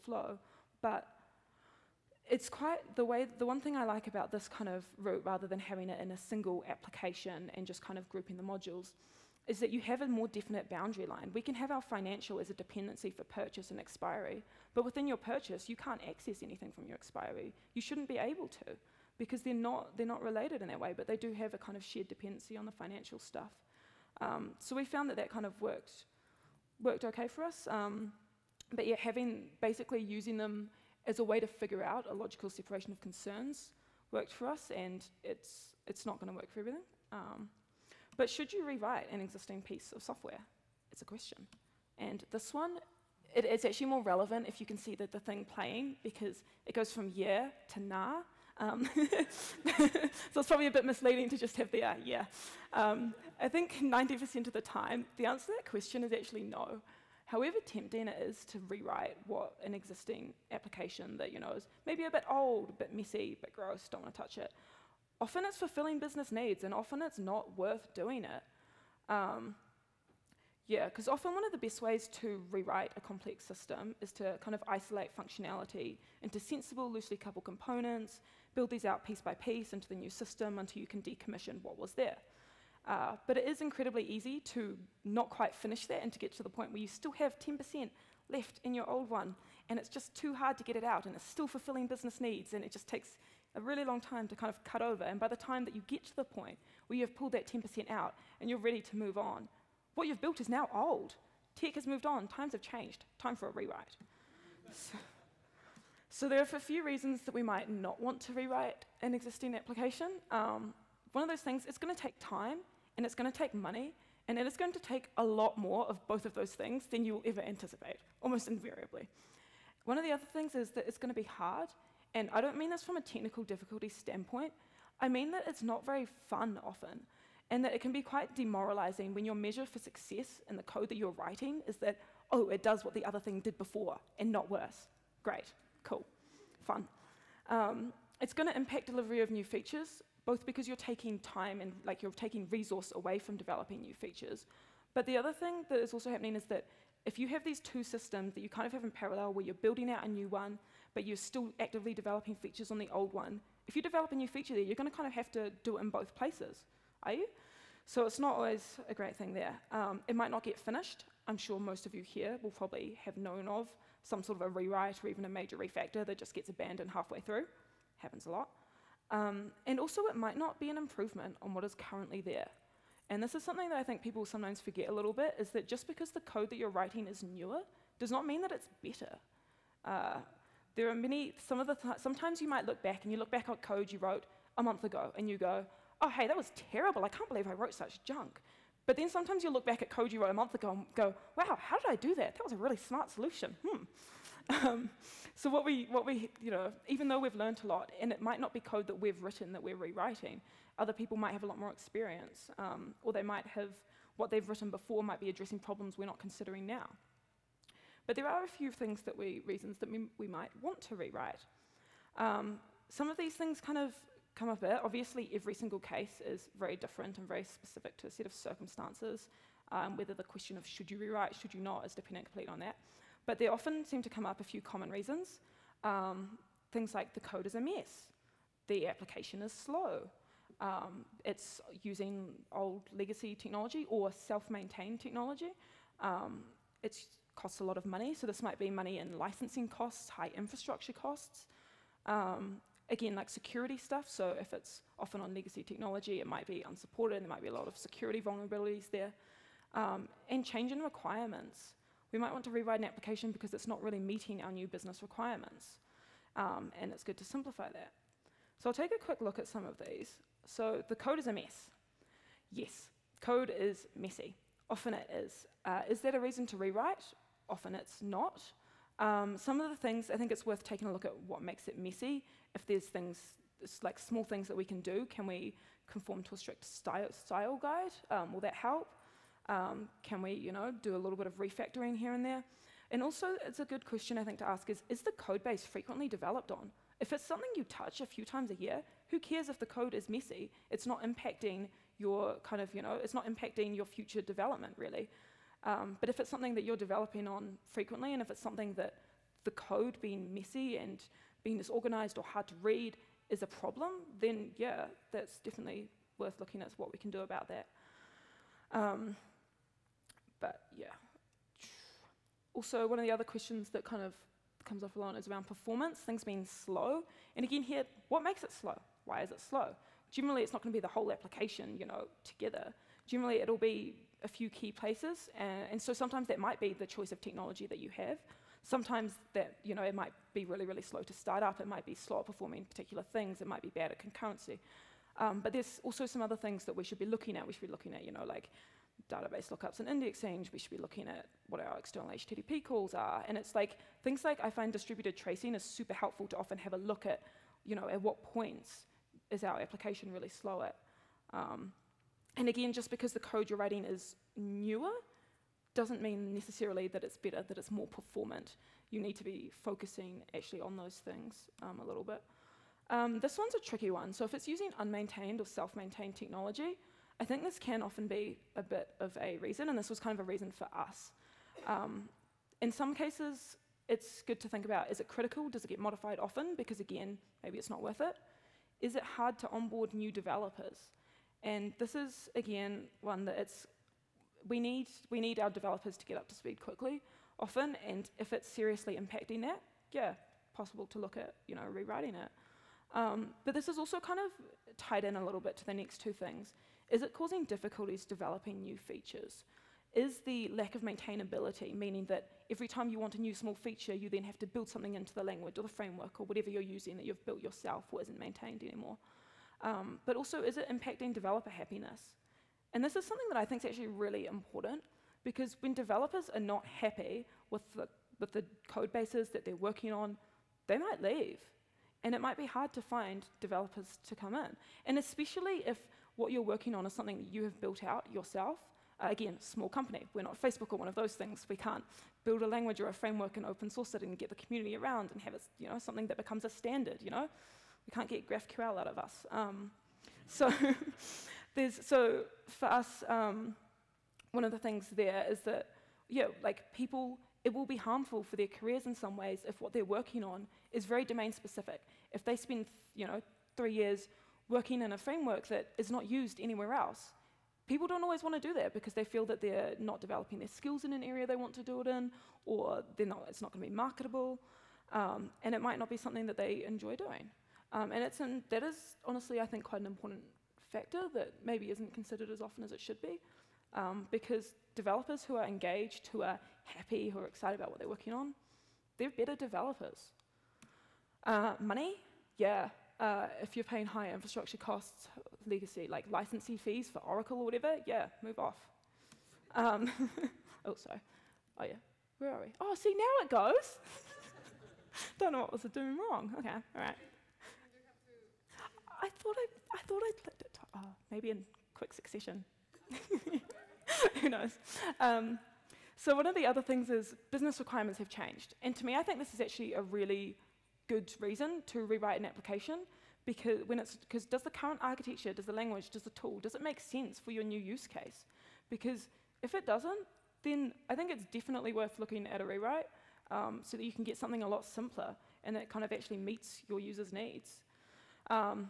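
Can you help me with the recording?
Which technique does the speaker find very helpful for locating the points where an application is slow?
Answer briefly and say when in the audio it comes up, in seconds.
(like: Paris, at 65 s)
distributed tracing, at 344 s.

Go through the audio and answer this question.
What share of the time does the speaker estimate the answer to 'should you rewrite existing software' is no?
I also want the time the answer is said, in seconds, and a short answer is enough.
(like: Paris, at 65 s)
90%, at 53 s.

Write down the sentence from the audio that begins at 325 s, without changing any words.
And, and so sometimes that might be the choice of technology that you have.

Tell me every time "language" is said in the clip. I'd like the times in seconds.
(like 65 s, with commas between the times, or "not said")
405 s, 432 s, 515 s.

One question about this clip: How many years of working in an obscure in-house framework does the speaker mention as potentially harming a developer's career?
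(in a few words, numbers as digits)
3 years.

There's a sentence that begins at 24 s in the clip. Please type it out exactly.
Um, so we found that that kind of worked, worked okay for us.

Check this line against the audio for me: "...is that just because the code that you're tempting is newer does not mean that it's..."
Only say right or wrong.
wrong.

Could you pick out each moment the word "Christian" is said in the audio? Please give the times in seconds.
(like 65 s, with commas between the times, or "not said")
not said.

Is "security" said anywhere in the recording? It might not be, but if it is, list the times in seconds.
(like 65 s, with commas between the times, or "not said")
243 s, 247 s.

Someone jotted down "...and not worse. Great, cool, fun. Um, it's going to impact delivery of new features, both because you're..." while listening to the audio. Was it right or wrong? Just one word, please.
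right.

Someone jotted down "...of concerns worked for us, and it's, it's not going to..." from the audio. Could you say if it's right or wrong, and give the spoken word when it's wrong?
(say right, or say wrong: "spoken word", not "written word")
right.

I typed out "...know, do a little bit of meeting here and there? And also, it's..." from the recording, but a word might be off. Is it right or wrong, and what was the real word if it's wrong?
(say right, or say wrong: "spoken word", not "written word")
wrong: "refactoring", not "meeting".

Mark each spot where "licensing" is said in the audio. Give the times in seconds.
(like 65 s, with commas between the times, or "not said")
239 s, 486 s.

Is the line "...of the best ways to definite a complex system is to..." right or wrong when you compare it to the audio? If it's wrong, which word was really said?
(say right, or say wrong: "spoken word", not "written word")
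wrong: "rewrite", not "definite".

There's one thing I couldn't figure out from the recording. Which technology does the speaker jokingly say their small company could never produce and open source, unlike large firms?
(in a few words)
GraphQL.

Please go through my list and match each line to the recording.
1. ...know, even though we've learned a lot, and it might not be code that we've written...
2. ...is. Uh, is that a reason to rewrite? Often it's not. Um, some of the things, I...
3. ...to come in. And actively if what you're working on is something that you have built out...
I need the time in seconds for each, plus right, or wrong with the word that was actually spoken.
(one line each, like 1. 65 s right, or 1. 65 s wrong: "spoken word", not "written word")
1. 196 s right
2. 265 s right
3. 423 s wrong: "especially", not "actively".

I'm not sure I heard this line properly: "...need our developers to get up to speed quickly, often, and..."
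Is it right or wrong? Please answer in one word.
right.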